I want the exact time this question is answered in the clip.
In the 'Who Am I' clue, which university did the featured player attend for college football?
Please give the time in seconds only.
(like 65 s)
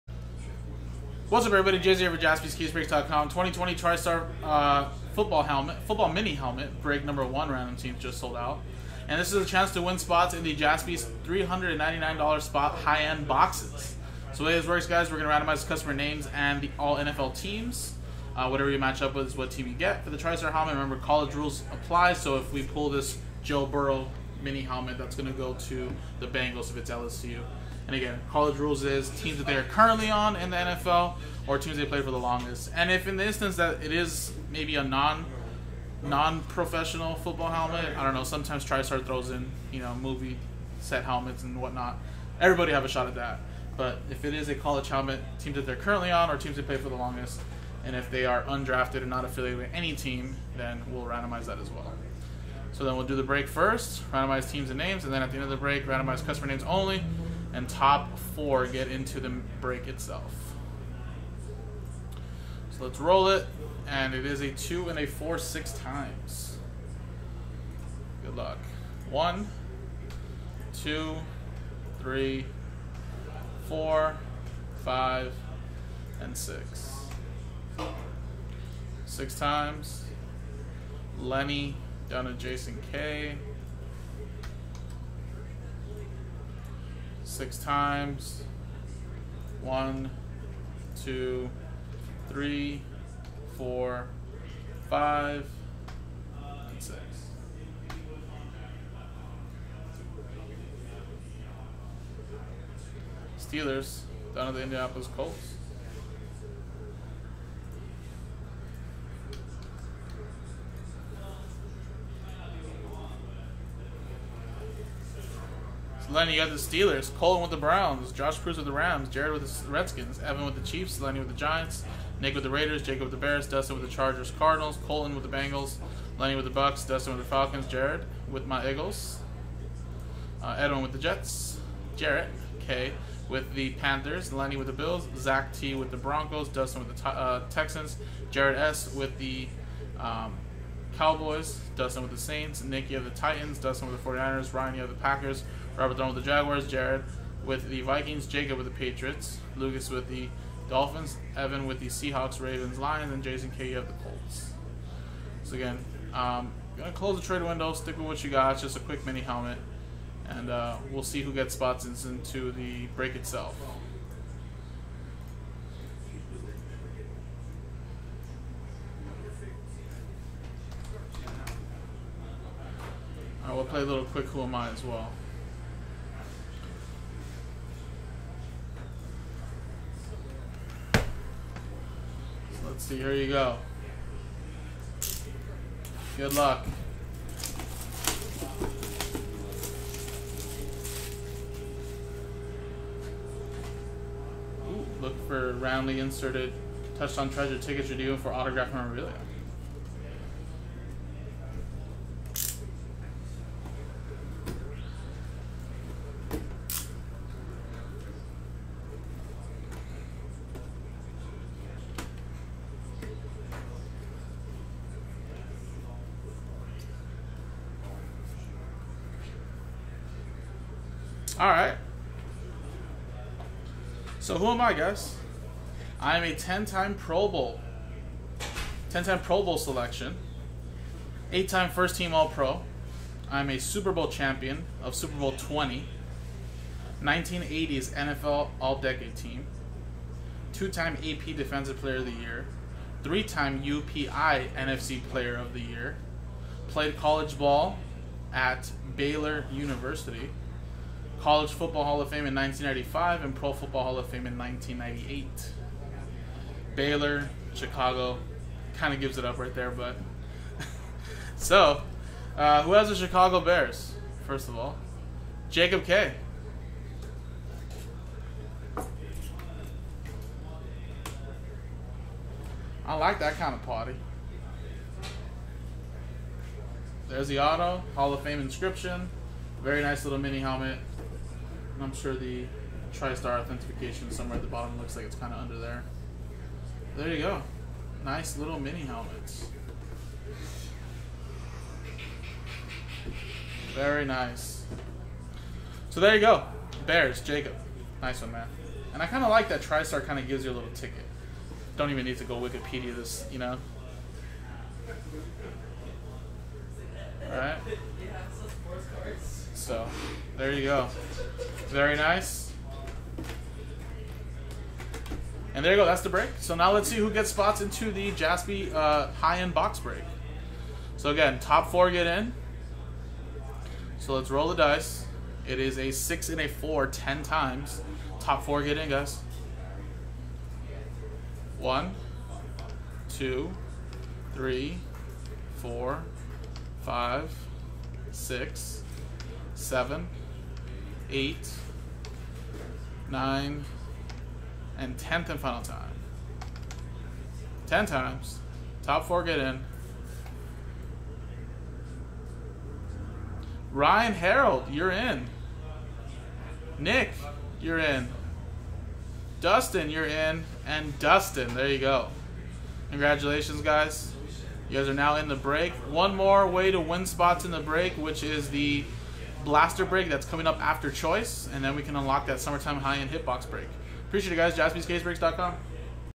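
248 s.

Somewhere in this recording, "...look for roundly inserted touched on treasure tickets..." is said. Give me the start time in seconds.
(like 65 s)
195 s.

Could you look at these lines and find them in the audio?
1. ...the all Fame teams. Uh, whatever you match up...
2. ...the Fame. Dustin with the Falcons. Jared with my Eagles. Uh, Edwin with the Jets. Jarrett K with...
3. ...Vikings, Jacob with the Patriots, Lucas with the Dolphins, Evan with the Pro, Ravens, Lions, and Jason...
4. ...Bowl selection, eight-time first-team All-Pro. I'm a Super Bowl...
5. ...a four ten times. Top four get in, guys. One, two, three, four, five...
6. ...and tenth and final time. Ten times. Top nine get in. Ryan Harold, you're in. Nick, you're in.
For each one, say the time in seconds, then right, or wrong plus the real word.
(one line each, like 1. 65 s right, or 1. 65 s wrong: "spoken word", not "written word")
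1. 16 s wrong: "NFL", not "Fame"
2. 126 s wrong: "Bucks", not "Fame"
3. 147 s wrong: "Seahawks", not "Pro"
4. 229 s right
5. 326 s right
6. 344 s wrong: "four", not "nine".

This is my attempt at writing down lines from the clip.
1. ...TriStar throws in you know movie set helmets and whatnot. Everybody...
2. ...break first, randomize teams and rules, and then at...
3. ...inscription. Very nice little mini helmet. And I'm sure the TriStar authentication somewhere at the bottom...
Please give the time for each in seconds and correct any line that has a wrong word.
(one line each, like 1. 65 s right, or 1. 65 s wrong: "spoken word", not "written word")
1. 38 s right
2. 53 s wrong: "names", not "rules"
3. 278 s right.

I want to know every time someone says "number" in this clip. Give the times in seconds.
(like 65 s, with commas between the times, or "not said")
7 s.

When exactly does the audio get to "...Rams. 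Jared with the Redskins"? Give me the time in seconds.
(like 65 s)
118 s.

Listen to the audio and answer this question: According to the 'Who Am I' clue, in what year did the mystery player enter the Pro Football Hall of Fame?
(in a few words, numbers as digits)
1998.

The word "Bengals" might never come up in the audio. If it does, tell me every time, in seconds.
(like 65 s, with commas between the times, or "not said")
26 s, 125 s.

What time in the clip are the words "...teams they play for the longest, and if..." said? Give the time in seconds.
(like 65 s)
46 s.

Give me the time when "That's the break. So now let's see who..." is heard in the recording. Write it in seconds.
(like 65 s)
315 s.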